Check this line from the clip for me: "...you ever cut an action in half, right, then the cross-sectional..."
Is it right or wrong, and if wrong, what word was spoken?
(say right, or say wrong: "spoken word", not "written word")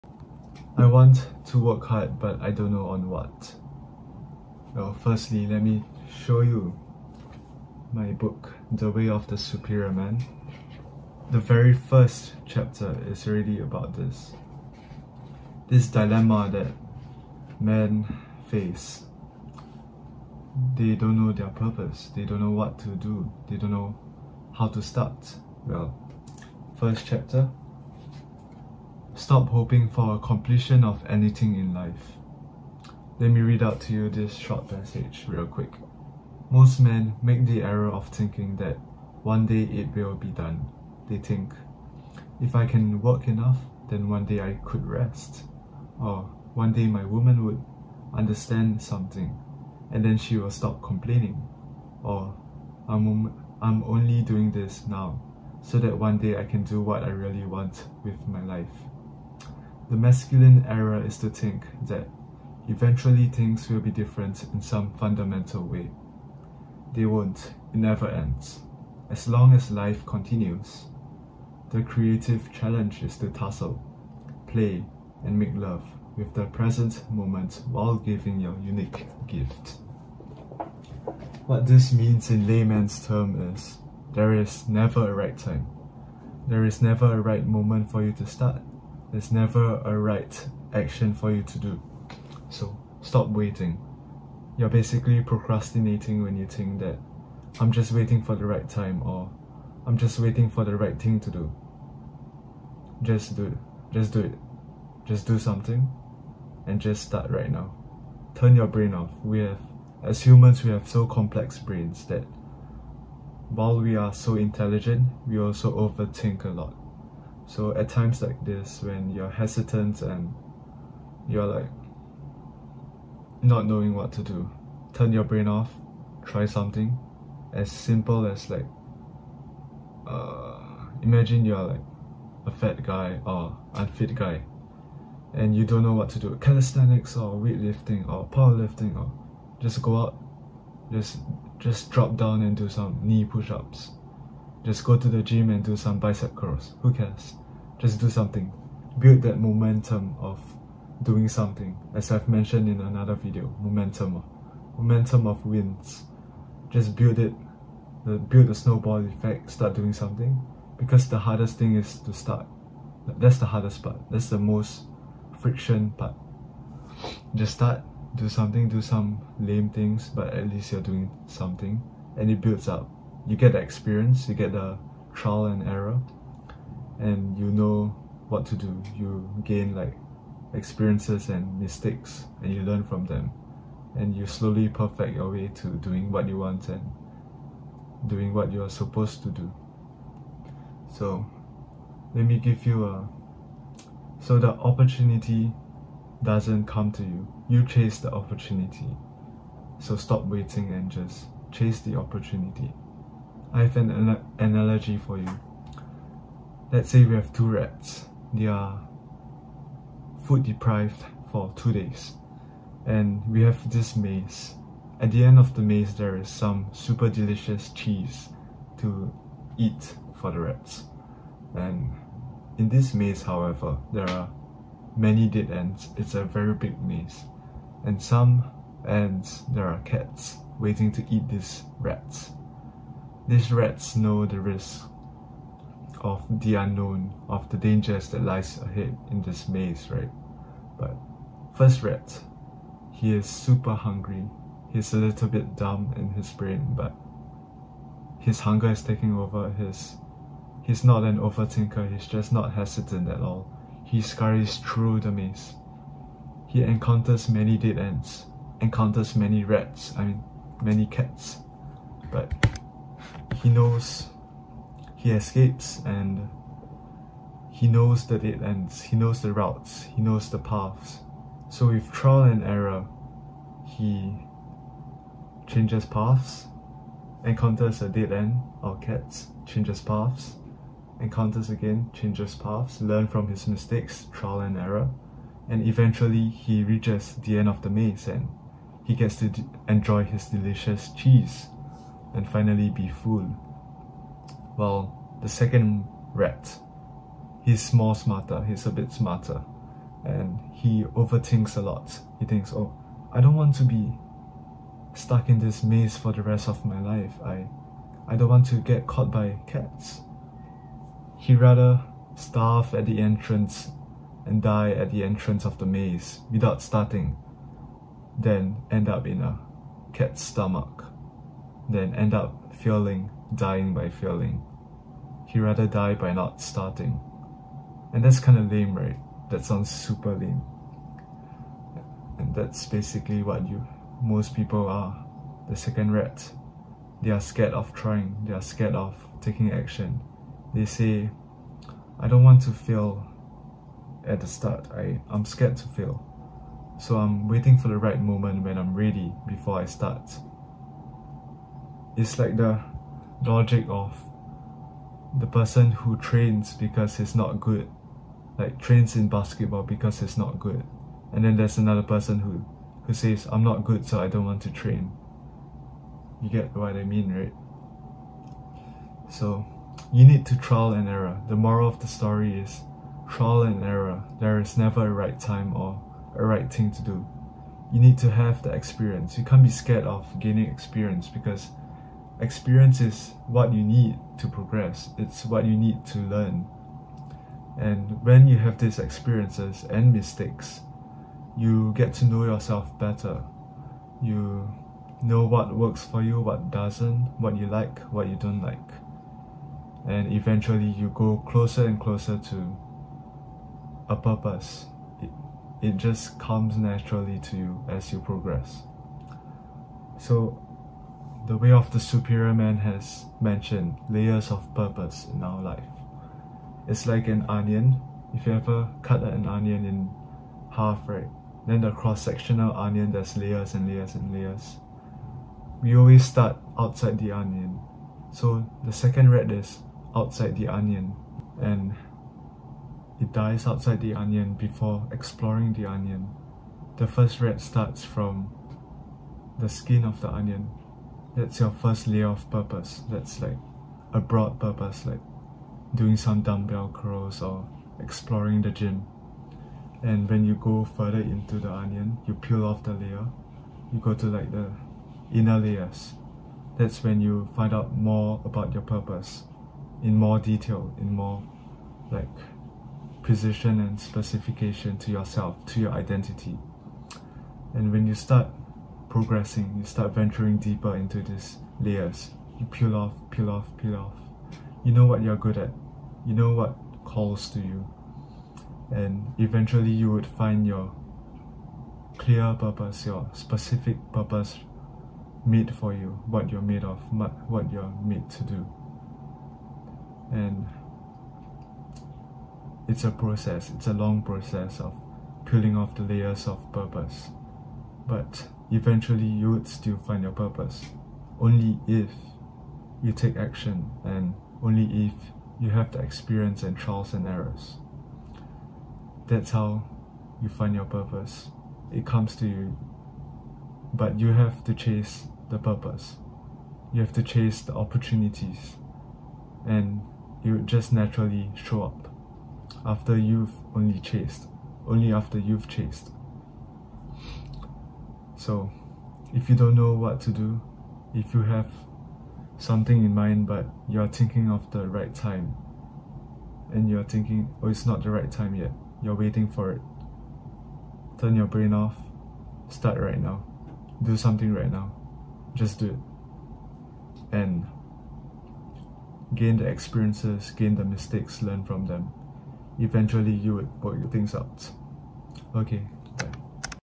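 wrong: "onion", not "action".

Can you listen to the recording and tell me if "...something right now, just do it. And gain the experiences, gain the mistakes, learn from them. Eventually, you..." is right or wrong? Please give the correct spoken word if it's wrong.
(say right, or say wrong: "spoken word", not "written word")
right.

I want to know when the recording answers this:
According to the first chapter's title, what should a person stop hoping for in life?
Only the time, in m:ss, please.
0:30.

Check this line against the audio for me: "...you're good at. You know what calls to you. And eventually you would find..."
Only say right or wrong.
right.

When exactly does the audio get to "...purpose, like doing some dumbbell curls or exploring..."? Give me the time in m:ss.
7:24.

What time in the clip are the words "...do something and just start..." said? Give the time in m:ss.
1:45.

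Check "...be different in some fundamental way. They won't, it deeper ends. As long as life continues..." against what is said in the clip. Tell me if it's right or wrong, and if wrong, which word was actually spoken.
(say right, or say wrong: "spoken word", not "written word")
wrong: "never", not "deeper".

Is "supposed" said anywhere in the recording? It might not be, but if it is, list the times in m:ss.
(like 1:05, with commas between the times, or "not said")
3:08.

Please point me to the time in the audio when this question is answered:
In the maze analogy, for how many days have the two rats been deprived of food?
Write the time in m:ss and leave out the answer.
3:31.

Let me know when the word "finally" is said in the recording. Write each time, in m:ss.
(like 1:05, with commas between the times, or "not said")
4:52.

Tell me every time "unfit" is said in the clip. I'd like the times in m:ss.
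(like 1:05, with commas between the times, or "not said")
2:13.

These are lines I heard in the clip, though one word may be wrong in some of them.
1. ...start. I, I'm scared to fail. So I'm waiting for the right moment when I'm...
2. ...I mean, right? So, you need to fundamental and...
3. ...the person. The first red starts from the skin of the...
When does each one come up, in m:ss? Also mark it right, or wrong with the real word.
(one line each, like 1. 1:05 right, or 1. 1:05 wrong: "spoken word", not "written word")
1. 5:44 right
2. 6:06 wrong: "trial", not "fundamental"
3. 7:15 wrong: "onion", not "person".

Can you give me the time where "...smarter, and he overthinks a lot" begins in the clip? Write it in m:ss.
4:58.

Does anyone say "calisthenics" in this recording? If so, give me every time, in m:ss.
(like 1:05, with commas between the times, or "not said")
2:16.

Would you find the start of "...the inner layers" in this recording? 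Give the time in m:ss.
7:34.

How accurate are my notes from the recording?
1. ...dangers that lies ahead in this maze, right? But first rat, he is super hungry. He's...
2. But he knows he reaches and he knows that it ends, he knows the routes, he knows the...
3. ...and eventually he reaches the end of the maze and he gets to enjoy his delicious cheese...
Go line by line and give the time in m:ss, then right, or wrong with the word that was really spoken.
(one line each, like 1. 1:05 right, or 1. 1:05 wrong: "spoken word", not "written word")
1. 3:57 right
2. 4:22 wrong: "escapes", not "reaches"
3. 4:45 right.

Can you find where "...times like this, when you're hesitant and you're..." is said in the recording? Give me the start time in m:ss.
1:57.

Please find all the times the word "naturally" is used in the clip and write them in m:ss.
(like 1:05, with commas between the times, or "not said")
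6:46, 8:40.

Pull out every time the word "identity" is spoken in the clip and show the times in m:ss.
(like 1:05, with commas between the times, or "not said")
7:45.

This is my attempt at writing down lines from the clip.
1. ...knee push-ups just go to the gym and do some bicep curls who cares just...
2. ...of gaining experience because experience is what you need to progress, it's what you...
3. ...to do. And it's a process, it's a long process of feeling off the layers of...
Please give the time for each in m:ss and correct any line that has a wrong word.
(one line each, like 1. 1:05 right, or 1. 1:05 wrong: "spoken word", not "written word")
1. 2:23 right
2. 6:19 right
3. 8:08 wrong: "peeling", not "feeling".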